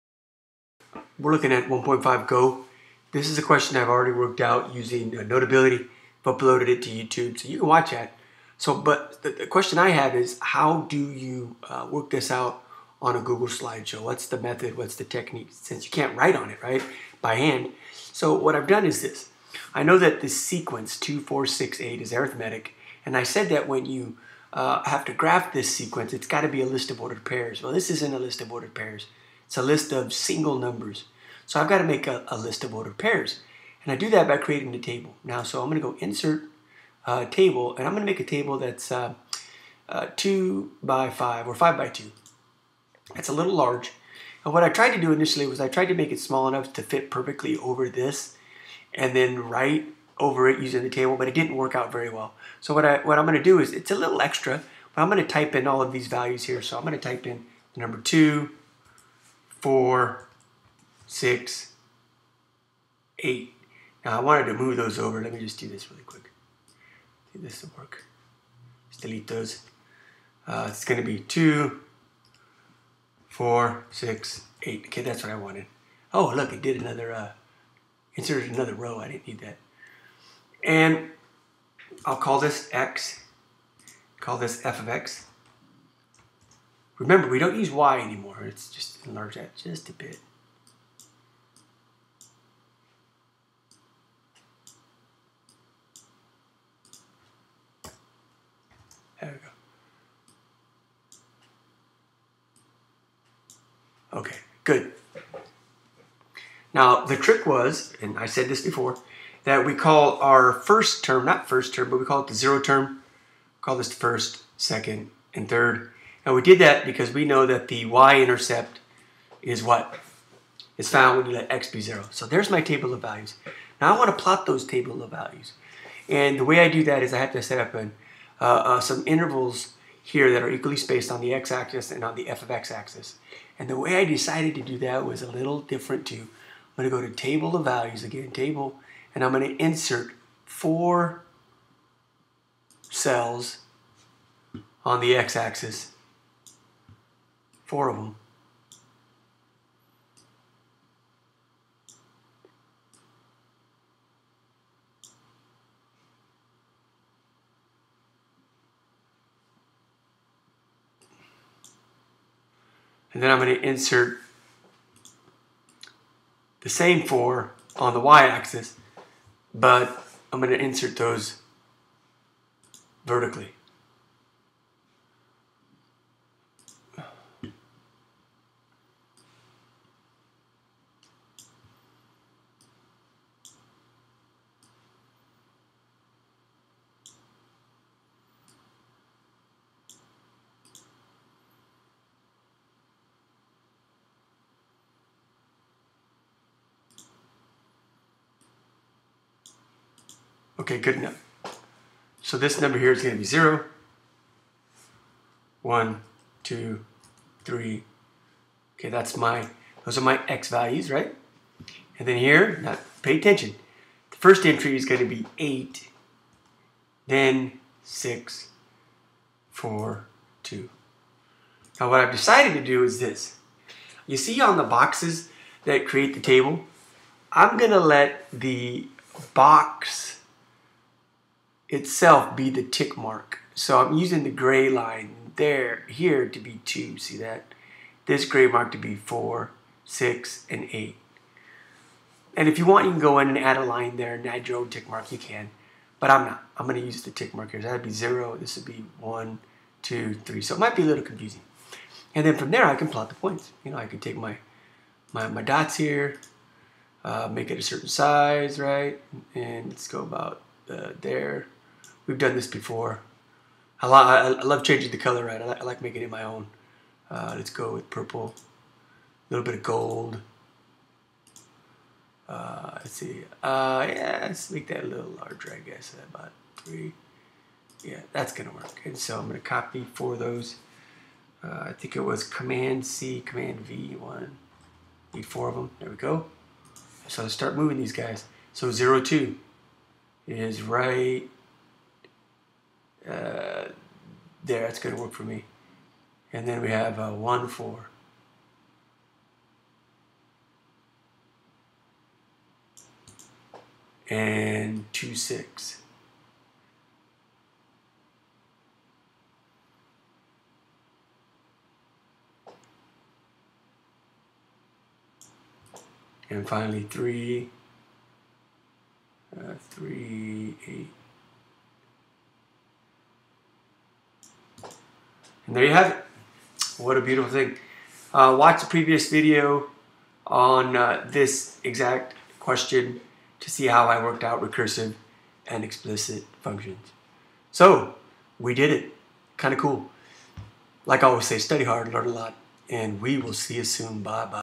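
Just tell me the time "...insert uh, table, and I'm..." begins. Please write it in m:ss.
0:35.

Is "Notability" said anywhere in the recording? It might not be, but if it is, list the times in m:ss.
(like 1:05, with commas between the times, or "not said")
0:05.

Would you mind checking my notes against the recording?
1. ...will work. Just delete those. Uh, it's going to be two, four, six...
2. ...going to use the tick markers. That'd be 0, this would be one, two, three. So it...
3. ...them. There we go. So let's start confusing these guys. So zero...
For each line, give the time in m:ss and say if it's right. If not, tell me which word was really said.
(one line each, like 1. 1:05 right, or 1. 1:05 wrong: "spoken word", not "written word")
1. 1:07 right
2. 4:06 right
3. 4:45 wrong: "moving", not "confusing".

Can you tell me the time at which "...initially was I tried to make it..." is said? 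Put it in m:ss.
0:45.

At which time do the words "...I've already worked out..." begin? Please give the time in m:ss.
0:03.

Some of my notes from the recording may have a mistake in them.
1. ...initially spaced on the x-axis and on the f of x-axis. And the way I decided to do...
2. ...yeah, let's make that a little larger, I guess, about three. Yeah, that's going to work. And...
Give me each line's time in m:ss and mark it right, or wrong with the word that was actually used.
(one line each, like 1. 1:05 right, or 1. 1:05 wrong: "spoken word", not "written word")
1. 2:10 wrong: "equally", not "initially"
2. 4:33 right.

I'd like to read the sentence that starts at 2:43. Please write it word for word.
and then I'm going to insert the same four on the y-axis, but I'm going to insert those vertically.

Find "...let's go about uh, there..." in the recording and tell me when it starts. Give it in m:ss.
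4:19.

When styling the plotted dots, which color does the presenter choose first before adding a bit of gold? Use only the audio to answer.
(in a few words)
purple.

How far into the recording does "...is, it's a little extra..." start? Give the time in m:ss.
0:53.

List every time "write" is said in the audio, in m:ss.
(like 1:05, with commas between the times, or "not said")
0:16.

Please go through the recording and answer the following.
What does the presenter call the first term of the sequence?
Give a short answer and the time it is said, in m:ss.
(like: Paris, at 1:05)
zero term, at 1:52.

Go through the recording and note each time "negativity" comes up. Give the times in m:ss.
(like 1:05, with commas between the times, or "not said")
not said.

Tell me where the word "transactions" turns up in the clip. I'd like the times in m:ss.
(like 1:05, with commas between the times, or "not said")
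not said.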